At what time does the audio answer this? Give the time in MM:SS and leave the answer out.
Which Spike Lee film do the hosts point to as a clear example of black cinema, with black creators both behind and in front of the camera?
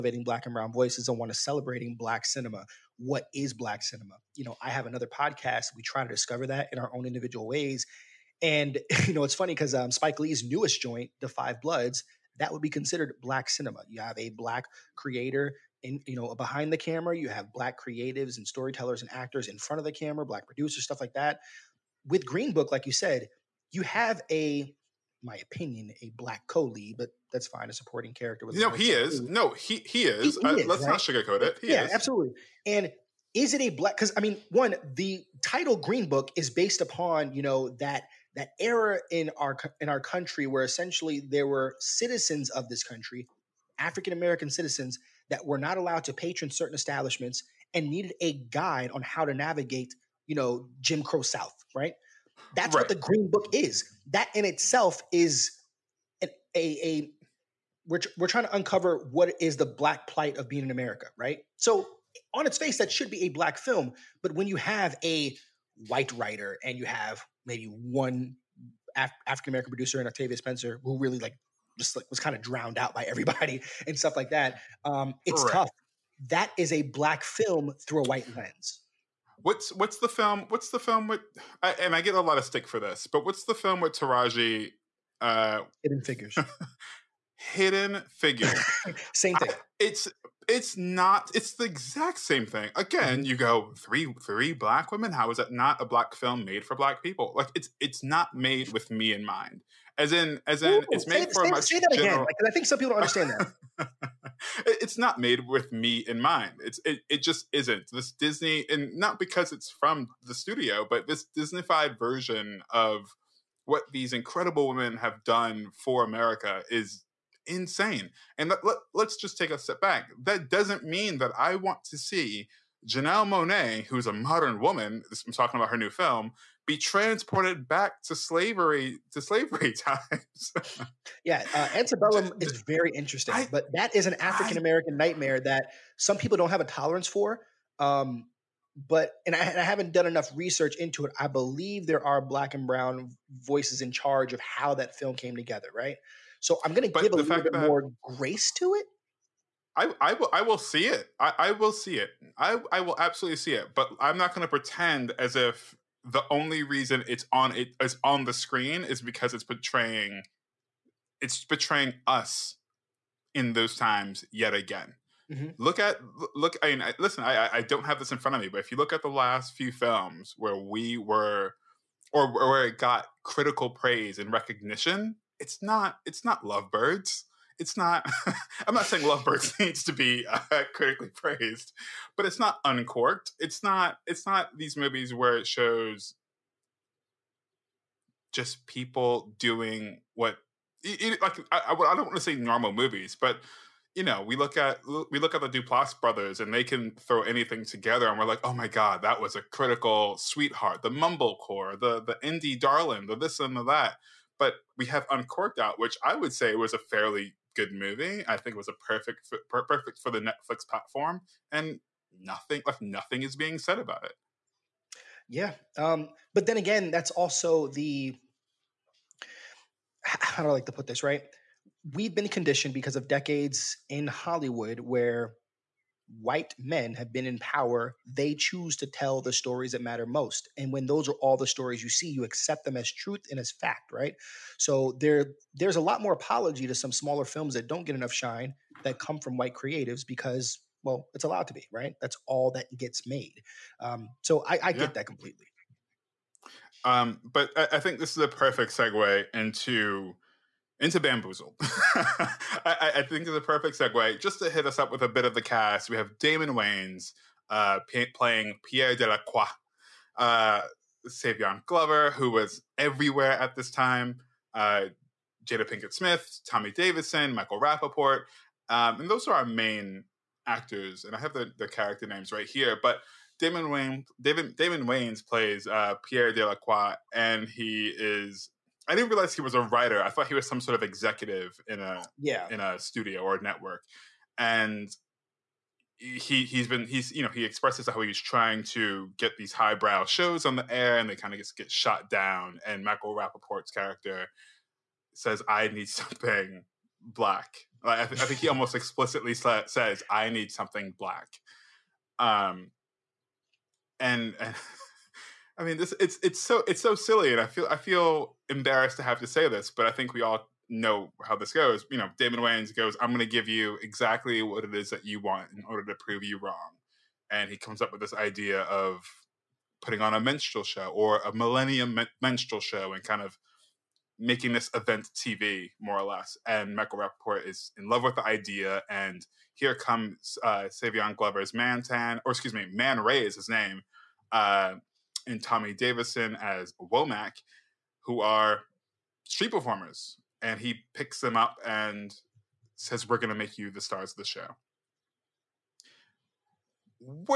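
00:11.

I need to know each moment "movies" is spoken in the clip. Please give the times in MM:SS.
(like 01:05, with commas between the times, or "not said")
03:04, 03:12, 03:27.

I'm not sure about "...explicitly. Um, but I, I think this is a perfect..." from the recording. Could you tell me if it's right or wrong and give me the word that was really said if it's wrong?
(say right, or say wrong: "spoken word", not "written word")
wrong: "completely", not "explicitly".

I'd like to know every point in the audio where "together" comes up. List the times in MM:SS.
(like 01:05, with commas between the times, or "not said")
02:25, 03:17.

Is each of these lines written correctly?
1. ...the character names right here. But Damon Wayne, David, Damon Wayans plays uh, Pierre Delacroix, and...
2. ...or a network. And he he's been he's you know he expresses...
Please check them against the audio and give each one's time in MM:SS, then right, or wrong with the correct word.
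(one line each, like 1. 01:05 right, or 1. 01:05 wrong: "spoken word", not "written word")
1. 04:31 right
2. 04:43 right.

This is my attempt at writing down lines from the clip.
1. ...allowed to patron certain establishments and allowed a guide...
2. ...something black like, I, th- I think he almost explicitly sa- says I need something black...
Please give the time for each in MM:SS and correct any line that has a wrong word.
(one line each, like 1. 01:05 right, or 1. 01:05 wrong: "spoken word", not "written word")
1. 00:45 wrong: "needed", not "allowed"
2. 04:55 right.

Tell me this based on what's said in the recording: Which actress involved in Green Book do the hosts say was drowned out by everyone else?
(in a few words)
Octavia Spencer.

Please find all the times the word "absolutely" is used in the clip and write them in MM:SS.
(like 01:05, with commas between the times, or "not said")
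00:31, 02:32.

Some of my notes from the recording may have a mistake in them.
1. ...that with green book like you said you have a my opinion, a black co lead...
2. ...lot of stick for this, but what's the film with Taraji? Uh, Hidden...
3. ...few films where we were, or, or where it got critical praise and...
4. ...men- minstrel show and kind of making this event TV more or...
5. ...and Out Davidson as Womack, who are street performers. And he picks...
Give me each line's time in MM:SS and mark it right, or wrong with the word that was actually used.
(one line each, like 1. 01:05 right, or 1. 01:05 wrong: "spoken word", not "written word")
1. 00:21 right
2. 01:22 right
3. 02:49 right
4. 05:21 right
5. 05:35 wrong: "Tommy", not "Out".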